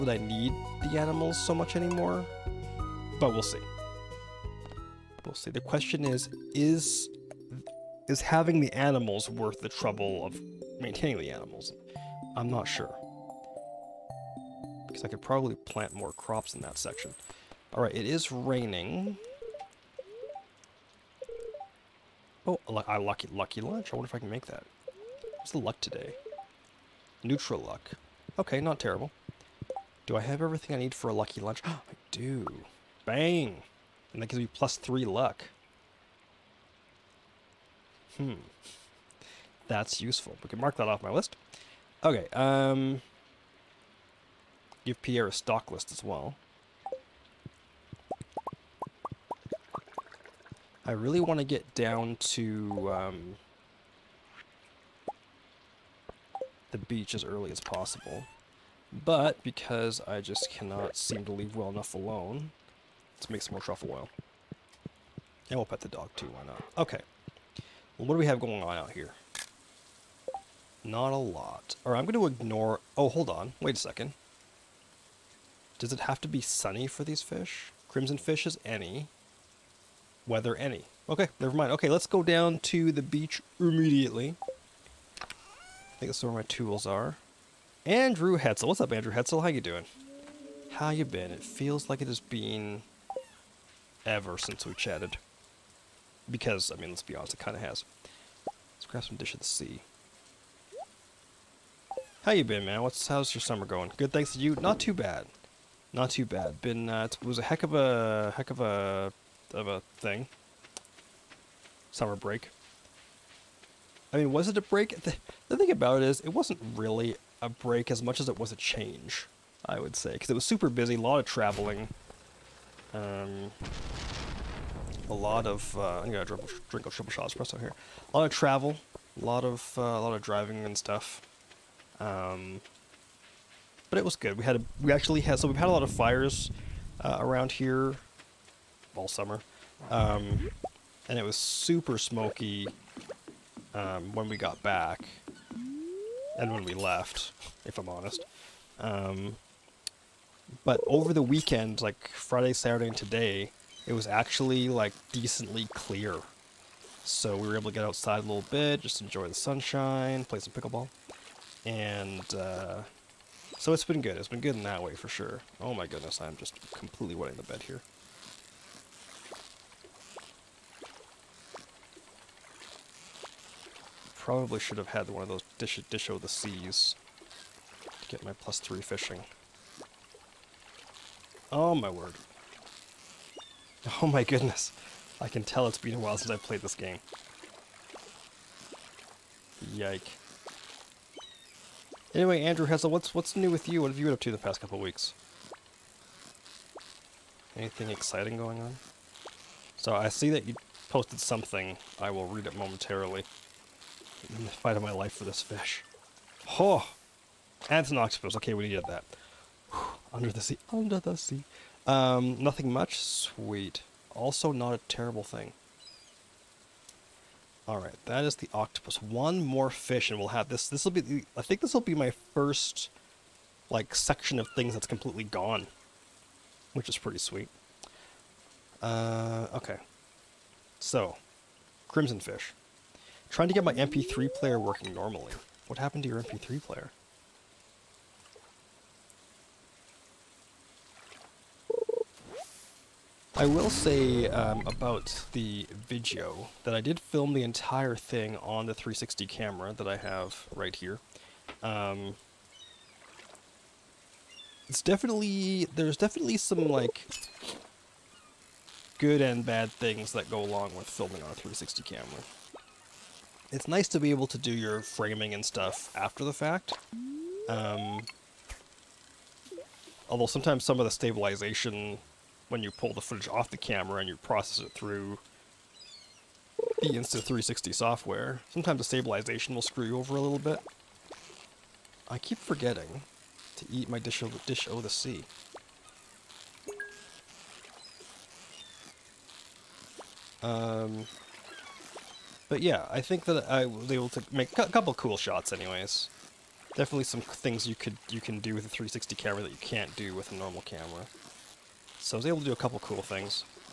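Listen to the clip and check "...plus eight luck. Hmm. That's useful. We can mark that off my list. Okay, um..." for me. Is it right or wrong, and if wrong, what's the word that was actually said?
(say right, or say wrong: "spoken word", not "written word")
wrong: "three", not "eight".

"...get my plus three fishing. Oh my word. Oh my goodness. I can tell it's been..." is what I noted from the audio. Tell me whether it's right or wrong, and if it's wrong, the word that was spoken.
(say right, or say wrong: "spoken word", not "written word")
right.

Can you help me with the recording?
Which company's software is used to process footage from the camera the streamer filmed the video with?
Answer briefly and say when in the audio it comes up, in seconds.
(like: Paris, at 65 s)
Insta360, at 276 s.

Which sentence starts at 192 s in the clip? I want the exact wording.
Anyway, Andrew Hessel, what's what's new with you?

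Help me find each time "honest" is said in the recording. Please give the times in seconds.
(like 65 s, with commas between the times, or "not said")
97 s, 147 s.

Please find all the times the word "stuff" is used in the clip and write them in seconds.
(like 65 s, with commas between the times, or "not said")
130 s, 265 s.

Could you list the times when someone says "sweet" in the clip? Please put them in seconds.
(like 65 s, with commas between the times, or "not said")
212 s, 227 s.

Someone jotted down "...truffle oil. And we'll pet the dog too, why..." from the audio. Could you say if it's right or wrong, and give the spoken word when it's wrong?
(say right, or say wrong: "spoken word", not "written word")
right.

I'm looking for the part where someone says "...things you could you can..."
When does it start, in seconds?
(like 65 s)
297 s.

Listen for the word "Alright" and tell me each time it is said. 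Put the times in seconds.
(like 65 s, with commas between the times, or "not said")
17 s, 217 s.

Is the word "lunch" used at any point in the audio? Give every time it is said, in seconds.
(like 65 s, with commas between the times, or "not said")
23 s, 31 s.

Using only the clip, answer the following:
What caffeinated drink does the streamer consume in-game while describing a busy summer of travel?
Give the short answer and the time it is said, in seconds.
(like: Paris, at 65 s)
Triple shot espresso, at 126 s.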